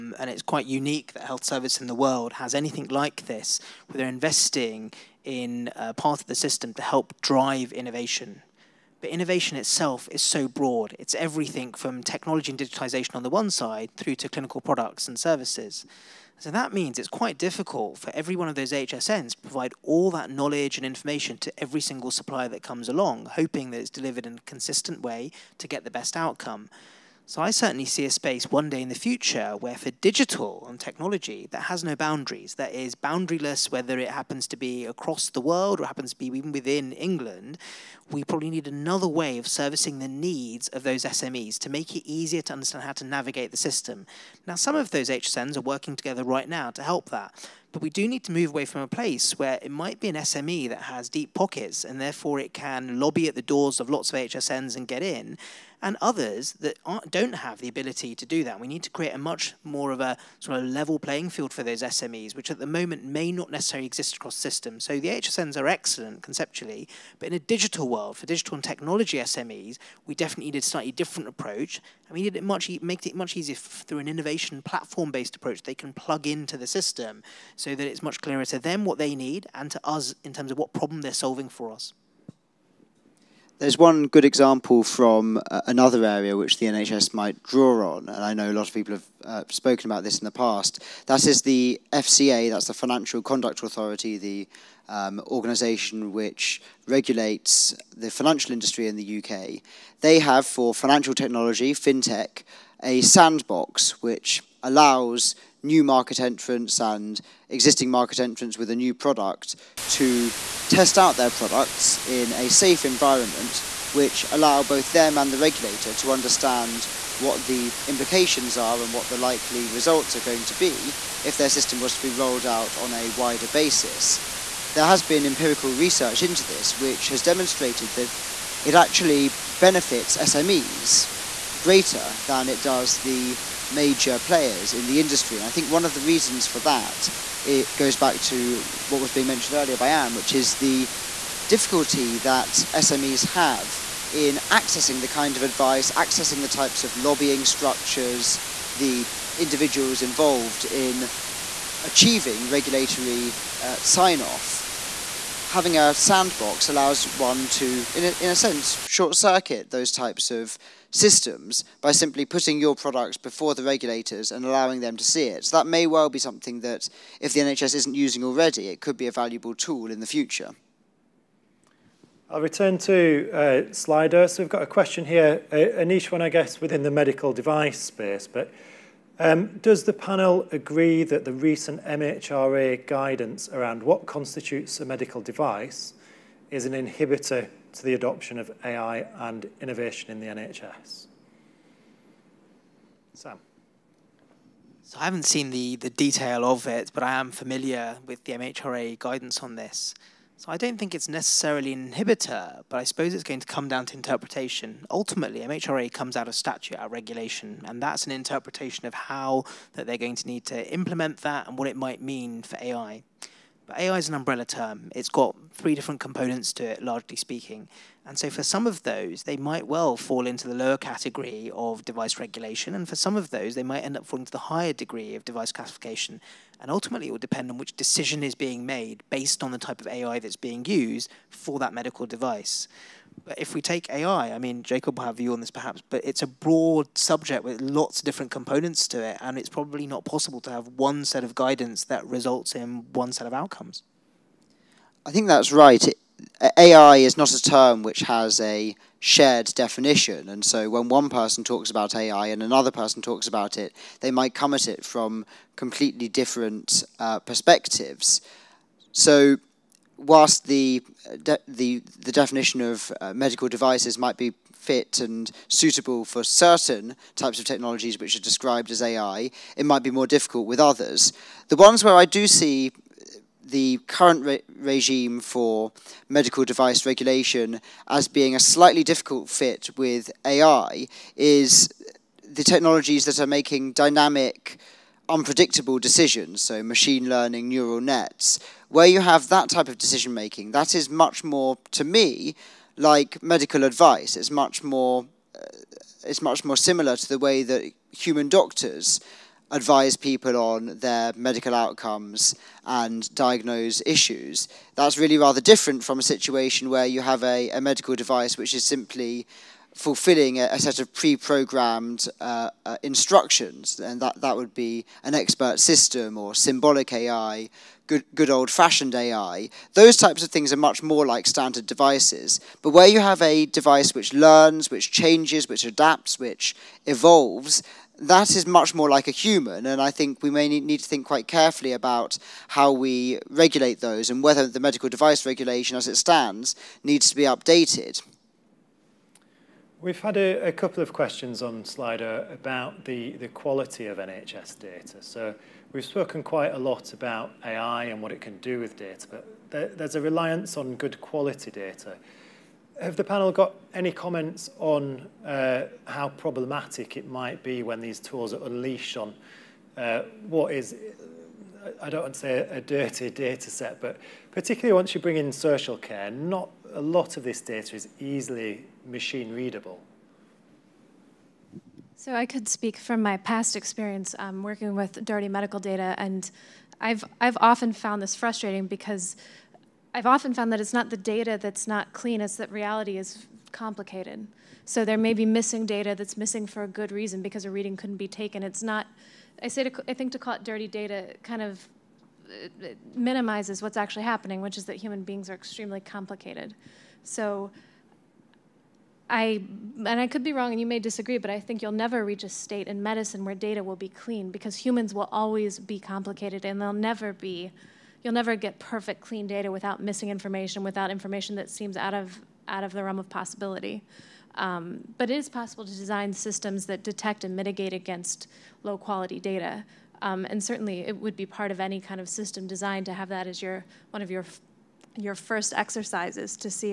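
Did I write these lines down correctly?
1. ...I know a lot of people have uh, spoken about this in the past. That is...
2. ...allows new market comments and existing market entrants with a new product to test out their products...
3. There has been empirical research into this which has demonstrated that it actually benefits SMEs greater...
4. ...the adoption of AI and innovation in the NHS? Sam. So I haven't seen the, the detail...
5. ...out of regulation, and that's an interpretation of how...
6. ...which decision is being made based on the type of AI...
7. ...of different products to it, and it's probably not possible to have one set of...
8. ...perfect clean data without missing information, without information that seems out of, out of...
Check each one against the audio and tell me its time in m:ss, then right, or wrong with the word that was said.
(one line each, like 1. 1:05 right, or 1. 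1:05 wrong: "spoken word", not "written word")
1. 1:28 right
2. 1:44 wrong: "entrants", not "comments"
3. 2:04 right
4. 3:07 right
5. 3:26 right
6. 3:47 right
7. 3:57 wrong: "components", not "products"
8. 6:48 right.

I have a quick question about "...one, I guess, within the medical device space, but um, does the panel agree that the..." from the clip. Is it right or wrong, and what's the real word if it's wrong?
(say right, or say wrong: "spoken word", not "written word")
right.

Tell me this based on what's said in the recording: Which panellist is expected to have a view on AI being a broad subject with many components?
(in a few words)
Jacob.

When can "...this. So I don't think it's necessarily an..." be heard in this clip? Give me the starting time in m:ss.
3:19.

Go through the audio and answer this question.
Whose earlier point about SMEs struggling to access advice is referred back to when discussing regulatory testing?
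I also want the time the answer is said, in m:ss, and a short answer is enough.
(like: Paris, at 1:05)
Anne, at 2:19.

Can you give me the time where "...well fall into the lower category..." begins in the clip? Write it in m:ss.
3:39.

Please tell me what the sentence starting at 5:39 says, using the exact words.
We've had a, a, couple of questions on Slido about the, the quality of NHS data.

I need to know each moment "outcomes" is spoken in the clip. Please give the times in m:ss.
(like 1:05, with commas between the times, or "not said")
0:26, 4:03, 5:01.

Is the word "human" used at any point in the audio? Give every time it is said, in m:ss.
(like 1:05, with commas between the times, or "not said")
4:57, 5:29, 6:34, 6:44.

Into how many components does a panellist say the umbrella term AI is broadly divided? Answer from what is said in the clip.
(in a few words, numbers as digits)
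3.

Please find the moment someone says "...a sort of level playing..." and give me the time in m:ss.
0:59.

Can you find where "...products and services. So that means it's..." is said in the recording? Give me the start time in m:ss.
0:14.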